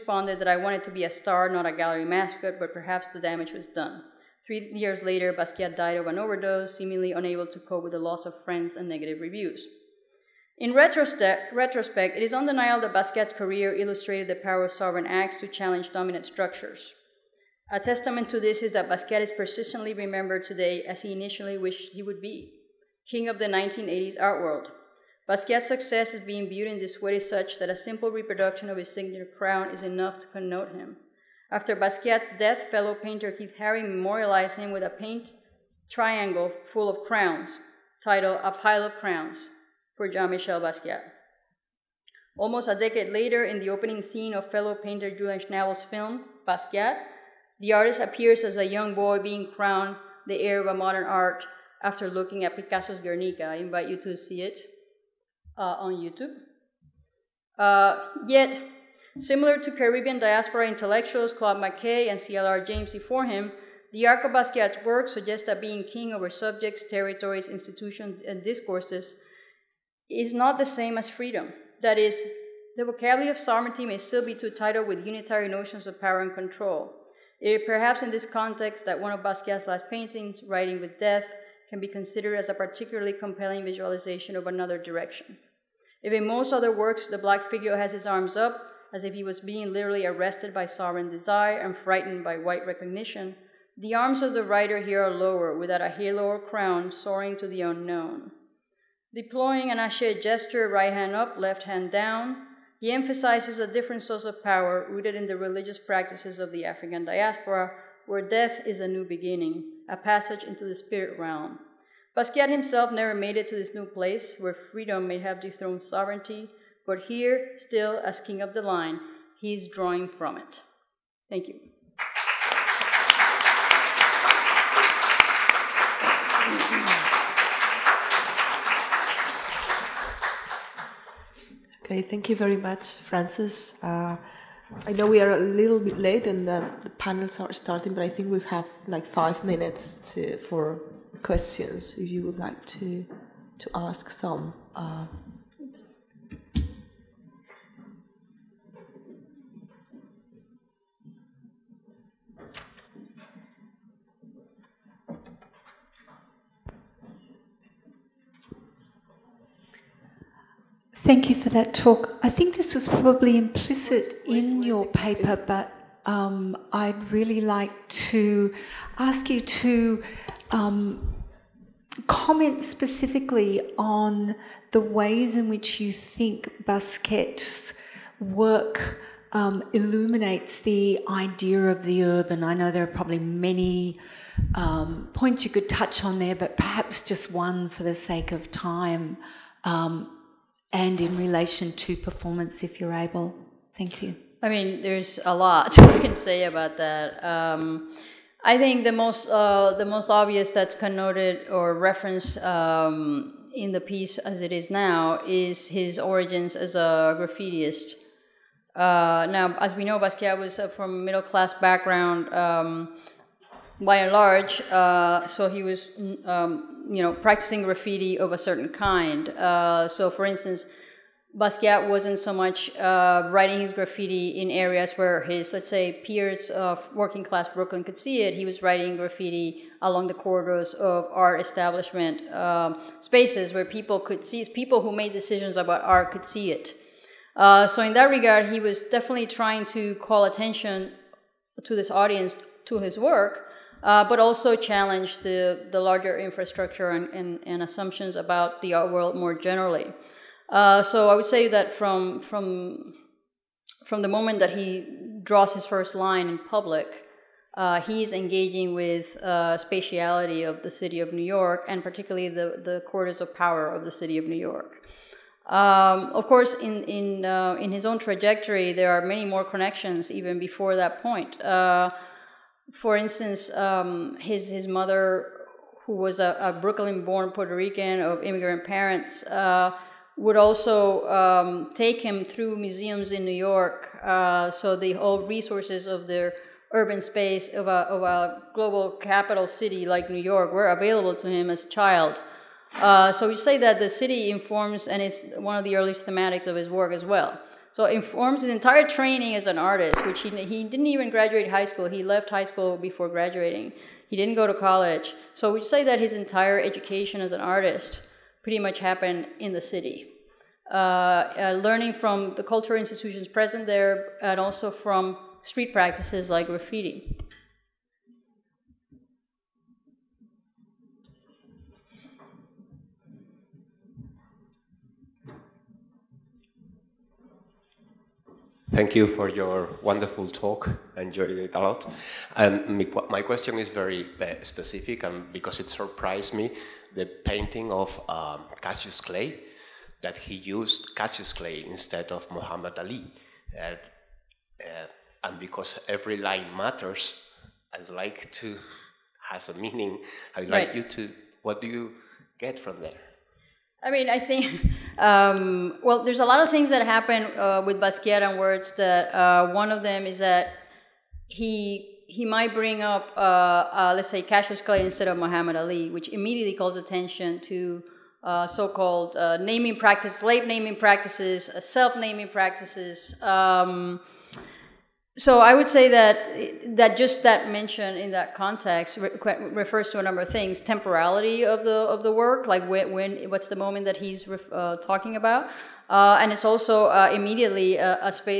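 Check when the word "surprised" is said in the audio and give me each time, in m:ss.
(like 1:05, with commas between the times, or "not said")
5:35.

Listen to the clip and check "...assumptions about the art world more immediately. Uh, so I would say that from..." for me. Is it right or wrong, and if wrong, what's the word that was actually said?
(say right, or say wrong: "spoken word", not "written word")
wrong: "generally", not "immediately".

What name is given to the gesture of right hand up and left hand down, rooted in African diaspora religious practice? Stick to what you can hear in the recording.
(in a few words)
ashe.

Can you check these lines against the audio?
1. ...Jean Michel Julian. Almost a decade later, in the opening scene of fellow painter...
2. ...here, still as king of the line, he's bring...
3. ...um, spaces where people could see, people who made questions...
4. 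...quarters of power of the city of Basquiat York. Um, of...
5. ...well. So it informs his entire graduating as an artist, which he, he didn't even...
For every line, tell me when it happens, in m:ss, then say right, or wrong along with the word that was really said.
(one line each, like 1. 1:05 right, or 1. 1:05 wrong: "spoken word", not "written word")
1. 0:40 wrong: "Basquiat", not "Julian"
2. 1:57 wrong: "drawing", not "bring"
3. 3:52 wrong: "decisions", not "questions"
4. 4:22 wrong: "New", not "Basquiat"
5. 4:57 wrong: "training", not "graduating".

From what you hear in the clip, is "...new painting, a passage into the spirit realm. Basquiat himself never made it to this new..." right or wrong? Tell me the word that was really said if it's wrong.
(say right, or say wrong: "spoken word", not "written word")
wrong: "beginning", not "painting".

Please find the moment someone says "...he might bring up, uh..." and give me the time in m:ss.
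6:02.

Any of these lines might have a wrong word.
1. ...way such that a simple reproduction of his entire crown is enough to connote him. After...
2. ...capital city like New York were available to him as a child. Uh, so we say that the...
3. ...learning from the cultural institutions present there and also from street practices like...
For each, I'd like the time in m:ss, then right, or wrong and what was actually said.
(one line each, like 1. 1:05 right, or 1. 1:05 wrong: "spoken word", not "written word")
1. 0:27 wrong: "signature", not "entire"
2. 4:48 right
3. 5:11 right.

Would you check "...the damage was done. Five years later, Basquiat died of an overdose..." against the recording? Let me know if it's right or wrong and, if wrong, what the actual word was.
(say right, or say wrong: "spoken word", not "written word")
wrong: "Three", not "Five".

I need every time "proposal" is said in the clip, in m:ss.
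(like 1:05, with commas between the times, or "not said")
not said.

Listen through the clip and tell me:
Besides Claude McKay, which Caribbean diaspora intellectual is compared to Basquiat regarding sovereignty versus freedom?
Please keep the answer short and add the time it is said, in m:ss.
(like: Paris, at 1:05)
CLR James, at 1:02.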